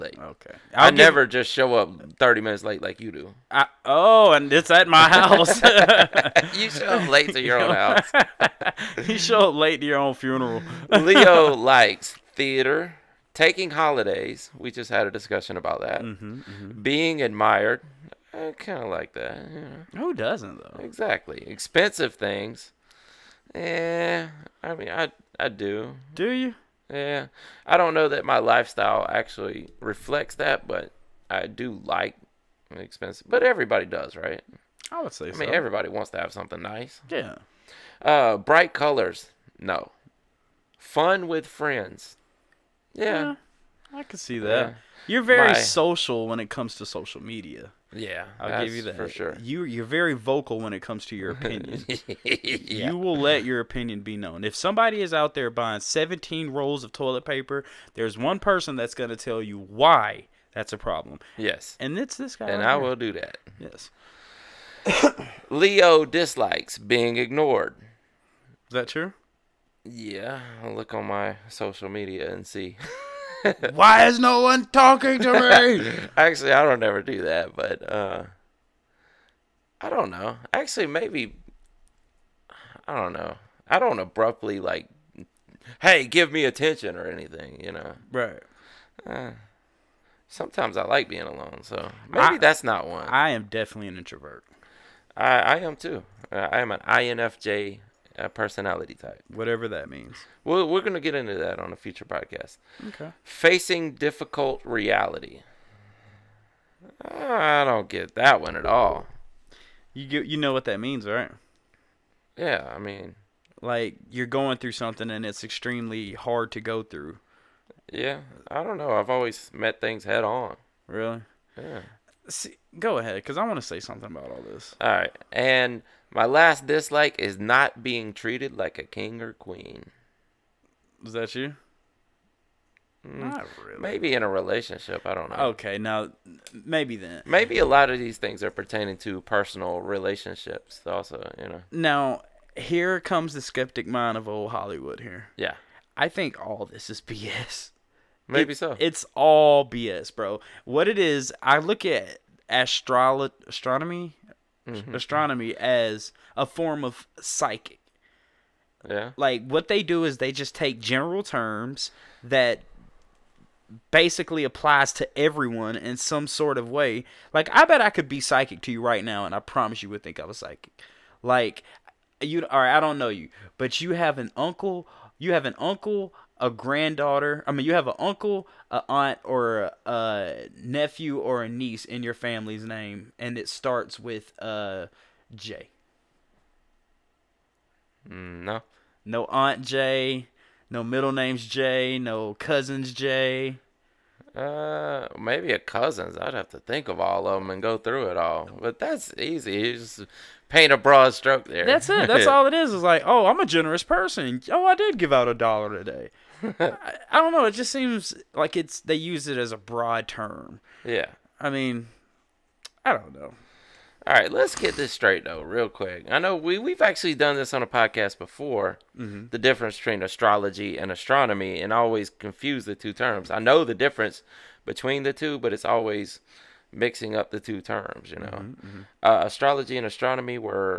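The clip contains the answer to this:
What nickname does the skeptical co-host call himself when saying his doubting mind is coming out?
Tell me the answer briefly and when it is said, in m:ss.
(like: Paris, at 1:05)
old Hollywood, at 2:24.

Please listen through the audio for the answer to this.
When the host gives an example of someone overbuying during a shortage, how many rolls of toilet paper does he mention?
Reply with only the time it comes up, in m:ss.
0:55.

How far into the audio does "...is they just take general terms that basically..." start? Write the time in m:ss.
2:40.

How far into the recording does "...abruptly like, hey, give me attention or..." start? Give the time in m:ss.
1:23.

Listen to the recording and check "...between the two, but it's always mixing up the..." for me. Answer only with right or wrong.
right.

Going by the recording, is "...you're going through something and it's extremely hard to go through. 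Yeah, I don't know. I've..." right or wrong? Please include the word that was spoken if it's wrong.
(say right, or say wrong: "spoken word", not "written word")
right.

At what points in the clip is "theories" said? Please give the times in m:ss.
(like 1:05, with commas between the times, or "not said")
not said.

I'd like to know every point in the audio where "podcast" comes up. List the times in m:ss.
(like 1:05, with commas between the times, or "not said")
1:42, 3:37.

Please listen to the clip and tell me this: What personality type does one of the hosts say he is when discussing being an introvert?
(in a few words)
INFJ.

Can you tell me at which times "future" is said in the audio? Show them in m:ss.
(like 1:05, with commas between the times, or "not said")
1:41.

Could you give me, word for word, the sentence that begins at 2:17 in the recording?
Maybe a lot of these things are pertaining to personal relationships, also.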